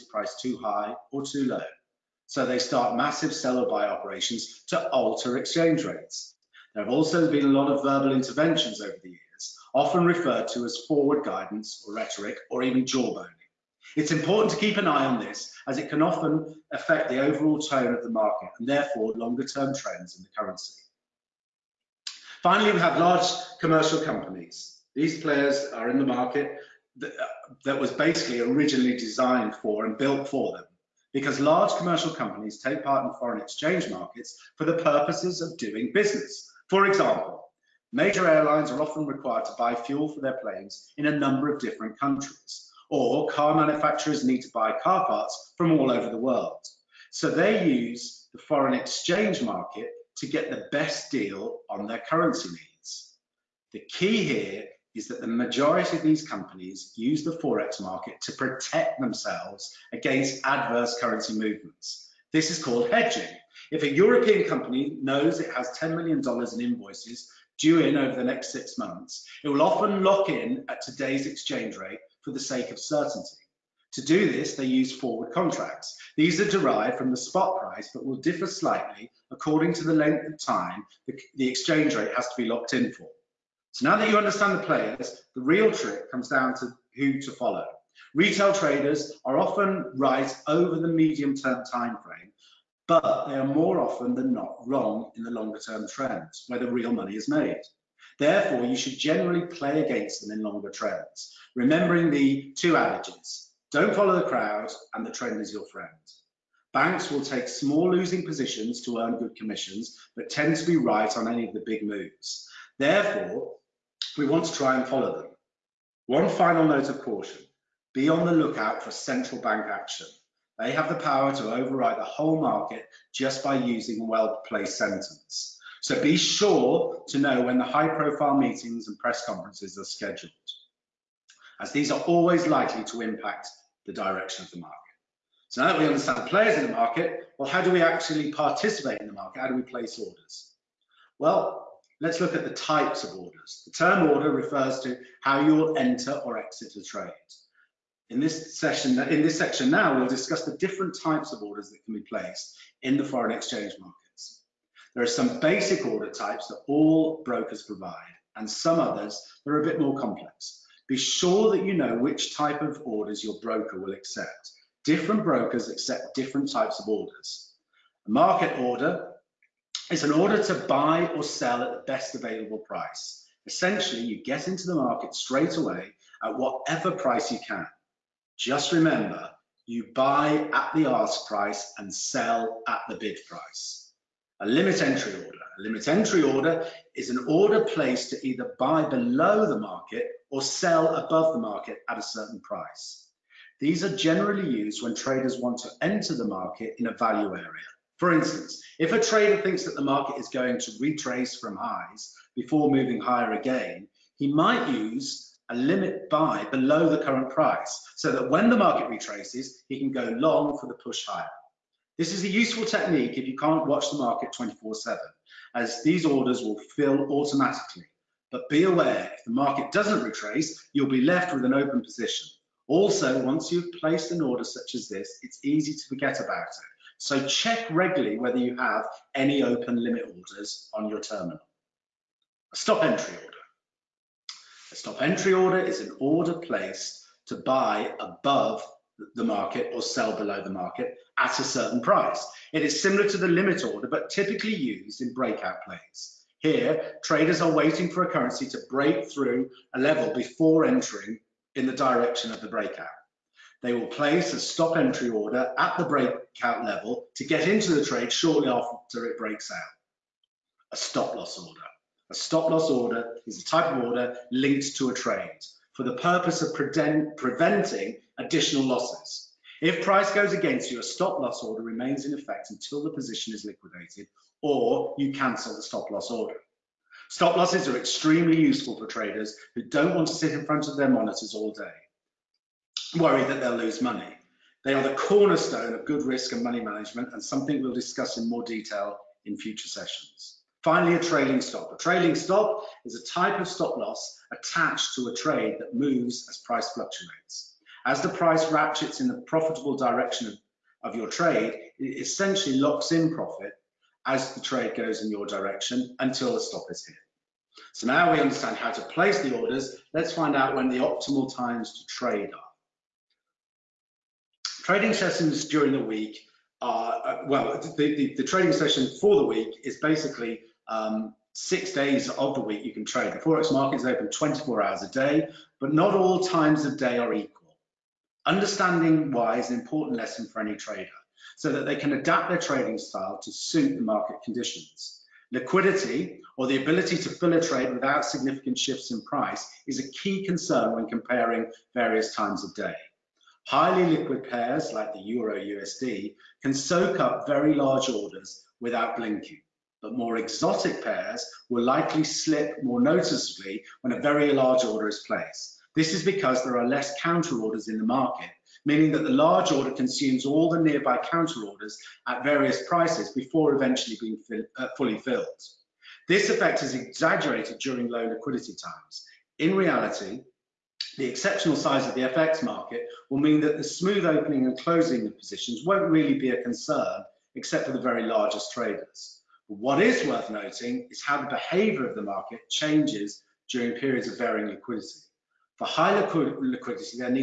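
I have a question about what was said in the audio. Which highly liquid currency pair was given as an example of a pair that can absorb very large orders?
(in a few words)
Euro USD.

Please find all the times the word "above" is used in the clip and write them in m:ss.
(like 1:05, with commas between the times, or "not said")
3:10, 3:57.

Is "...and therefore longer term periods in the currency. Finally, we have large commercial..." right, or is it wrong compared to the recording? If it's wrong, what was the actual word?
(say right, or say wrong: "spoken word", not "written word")
wrong: "trends", not "periods".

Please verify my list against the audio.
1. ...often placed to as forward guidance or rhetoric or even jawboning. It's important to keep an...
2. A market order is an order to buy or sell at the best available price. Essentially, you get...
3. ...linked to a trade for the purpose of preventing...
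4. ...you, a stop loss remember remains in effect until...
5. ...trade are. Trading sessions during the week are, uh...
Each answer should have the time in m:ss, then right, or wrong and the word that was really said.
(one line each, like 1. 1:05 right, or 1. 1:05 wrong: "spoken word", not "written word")
1. 0:09 wrong: "referred", not "placed"
2. 2:48 right
3. 4:24 right
4. 4:30 wrong: "order", not "remember"
5. 5:11 right.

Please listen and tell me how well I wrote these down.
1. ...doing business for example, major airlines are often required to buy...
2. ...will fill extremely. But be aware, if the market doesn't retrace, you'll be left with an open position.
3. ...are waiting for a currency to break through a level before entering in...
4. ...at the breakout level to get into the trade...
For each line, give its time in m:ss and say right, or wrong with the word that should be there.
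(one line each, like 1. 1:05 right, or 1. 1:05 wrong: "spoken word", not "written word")
1. 0:35 right
2. 3:36 wrong: "automatically", not "extremely"
3. 4:07 right
4. 4:15 right.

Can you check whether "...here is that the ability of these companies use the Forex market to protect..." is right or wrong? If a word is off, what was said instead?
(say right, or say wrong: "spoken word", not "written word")
wrong: "majority", not "ability".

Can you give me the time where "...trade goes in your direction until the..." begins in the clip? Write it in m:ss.
5:04.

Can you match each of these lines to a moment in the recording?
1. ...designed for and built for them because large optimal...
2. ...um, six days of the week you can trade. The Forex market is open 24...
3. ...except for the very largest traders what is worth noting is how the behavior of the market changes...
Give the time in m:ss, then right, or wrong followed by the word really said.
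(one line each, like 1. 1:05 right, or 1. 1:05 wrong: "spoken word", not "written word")
1. 0:28 wrong: "commercial", not "optimal"
2. 5:20 right
3. 6:17 right.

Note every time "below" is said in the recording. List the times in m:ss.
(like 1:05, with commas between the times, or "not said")
3:08, 3:26, 4:00.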